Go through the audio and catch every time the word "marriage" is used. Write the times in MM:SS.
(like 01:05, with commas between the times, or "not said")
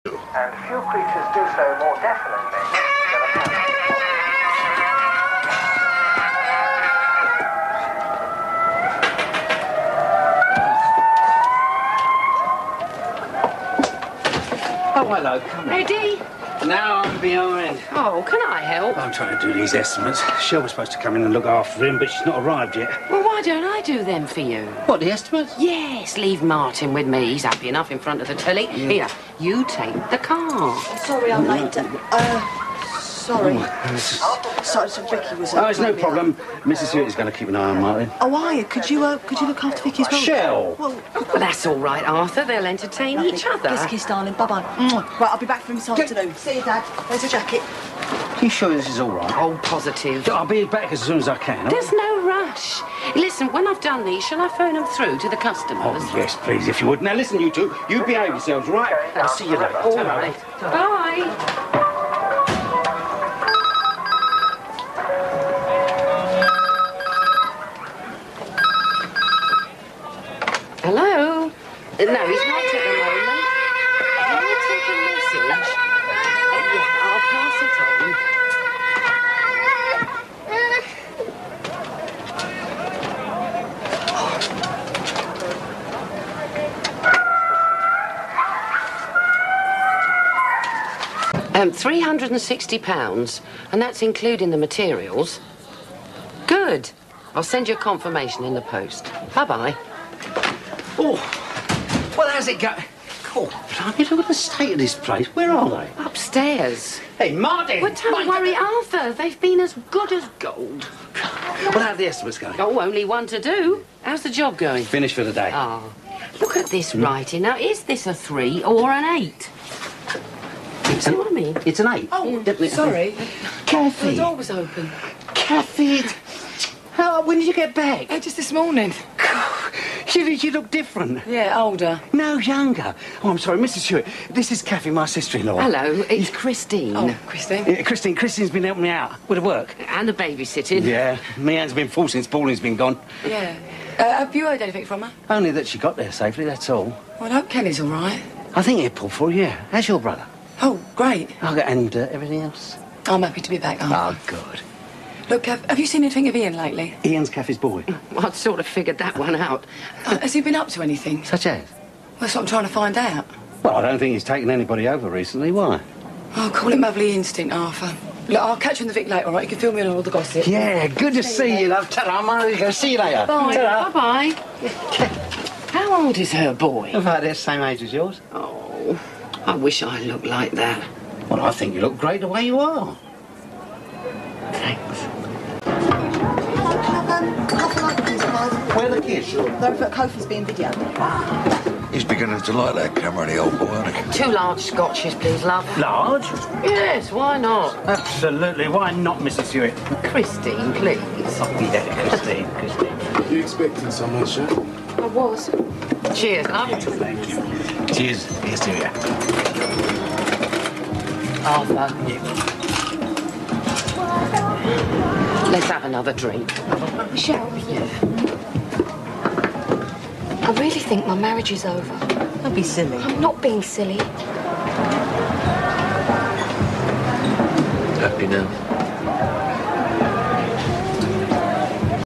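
03:41.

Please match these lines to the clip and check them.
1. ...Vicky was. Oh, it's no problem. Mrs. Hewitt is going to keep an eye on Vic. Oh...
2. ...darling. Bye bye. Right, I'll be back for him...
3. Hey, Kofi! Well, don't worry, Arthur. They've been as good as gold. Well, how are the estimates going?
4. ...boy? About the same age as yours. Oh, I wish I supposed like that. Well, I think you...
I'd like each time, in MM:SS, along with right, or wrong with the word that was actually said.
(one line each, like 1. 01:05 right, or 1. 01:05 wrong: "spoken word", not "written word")
1. 00:35 wrong: "Martin", not "Vic"
2. 00:44 right
3. 01:47 wrong: "Martin", not "Kofi"
4. 02:56 wrong: "looked", not "supposed".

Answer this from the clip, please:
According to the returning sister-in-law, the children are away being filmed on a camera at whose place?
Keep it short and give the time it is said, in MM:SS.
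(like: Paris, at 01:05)
Kofi's, at 03:09.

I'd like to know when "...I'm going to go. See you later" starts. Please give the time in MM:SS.
02:52.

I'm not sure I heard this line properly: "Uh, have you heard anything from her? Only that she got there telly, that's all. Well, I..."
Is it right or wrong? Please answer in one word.
wrong.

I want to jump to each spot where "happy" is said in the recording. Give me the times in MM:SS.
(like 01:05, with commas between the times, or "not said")
00:27, 02:33.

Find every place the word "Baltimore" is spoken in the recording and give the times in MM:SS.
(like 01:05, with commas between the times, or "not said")
not said.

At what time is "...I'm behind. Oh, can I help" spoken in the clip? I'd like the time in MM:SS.
00:17.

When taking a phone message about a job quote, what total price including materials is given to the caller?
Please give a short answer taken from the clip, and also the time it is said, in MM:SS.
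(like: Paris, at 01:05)
£360, at 01:31.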